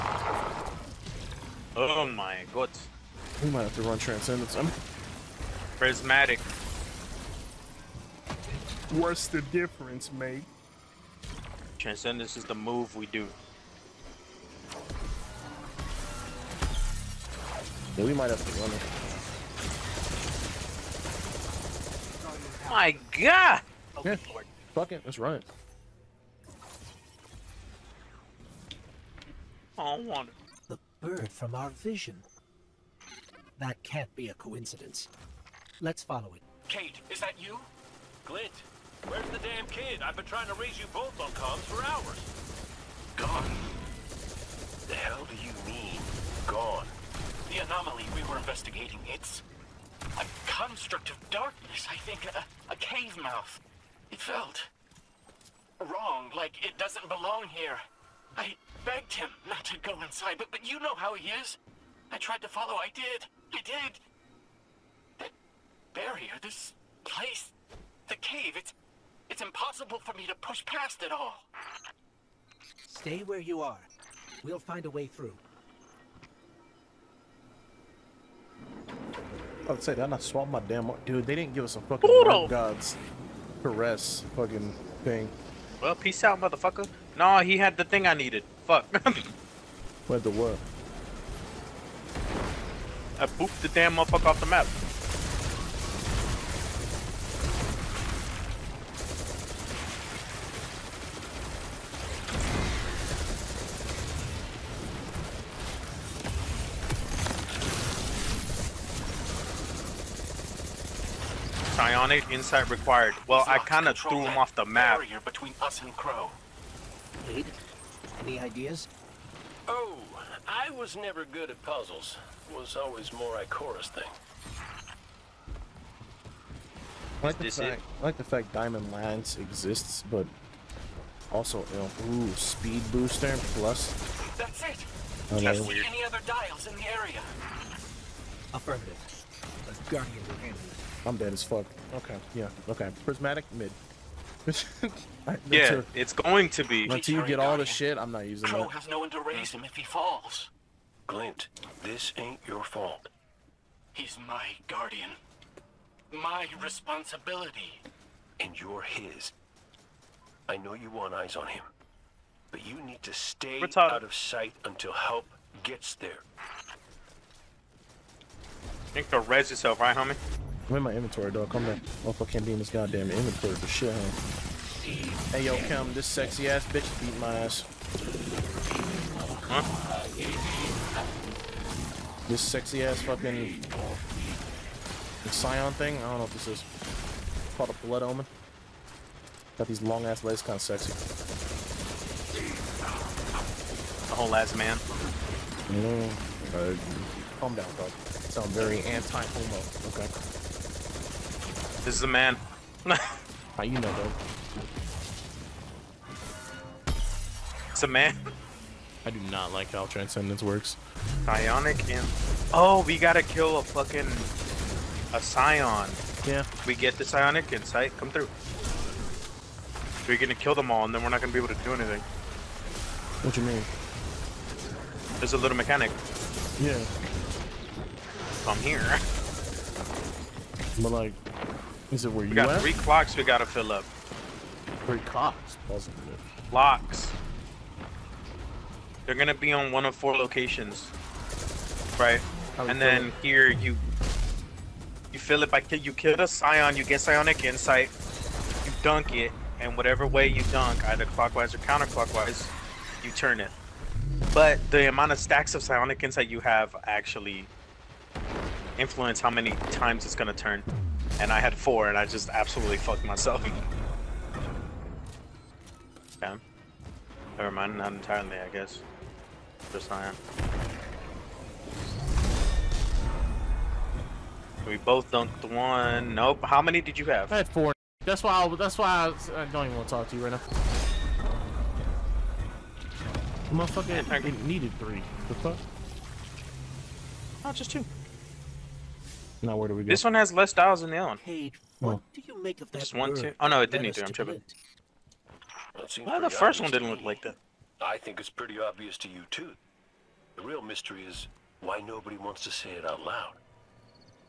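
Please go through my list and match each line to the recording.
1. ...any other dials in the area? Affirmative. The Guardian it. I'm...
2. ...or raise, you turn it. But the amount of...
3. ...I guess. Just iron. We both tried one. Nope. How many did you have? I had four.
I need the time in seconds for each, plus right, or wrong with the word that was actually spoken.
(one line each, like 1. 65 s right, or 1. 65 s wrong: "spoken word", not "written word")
1. 135 s right
2. 251 s wrong: "counterclockwise", not "raise"
3. 268 s wrong: "dunked", not "tried".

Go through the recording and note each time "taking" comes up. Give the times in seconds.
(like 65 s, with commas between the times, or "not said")
not said.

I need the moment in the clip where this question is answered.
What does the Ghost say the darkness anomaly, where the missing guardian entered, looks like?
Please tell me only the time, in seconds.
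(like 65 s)
52 s.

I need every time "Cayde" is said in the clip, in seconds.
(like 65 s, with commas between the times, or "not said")
36 s, 291 s.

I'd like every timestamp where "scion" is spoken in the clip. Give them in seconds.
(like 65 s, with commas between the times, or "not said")
185 s, 215 s, 246 s.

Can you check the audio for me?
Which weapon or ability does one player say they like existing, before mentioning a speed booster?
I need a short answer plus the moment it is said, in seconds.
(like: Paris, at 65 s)
Diamond Lance, at 128 s.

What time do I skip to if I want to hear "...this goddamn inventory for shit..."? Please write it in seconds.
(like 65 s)
172 s.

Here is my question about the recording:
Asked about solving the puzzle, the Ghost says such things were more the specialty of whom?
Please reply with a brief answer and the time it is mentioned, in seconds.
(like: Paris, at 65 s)
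Chorus, at 123 s.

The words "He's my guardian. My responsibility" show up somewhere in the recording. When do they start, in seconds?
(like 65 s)
153 s.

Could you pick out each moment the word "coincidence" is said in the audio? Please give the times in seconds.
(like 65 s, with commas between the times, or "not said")
34 s.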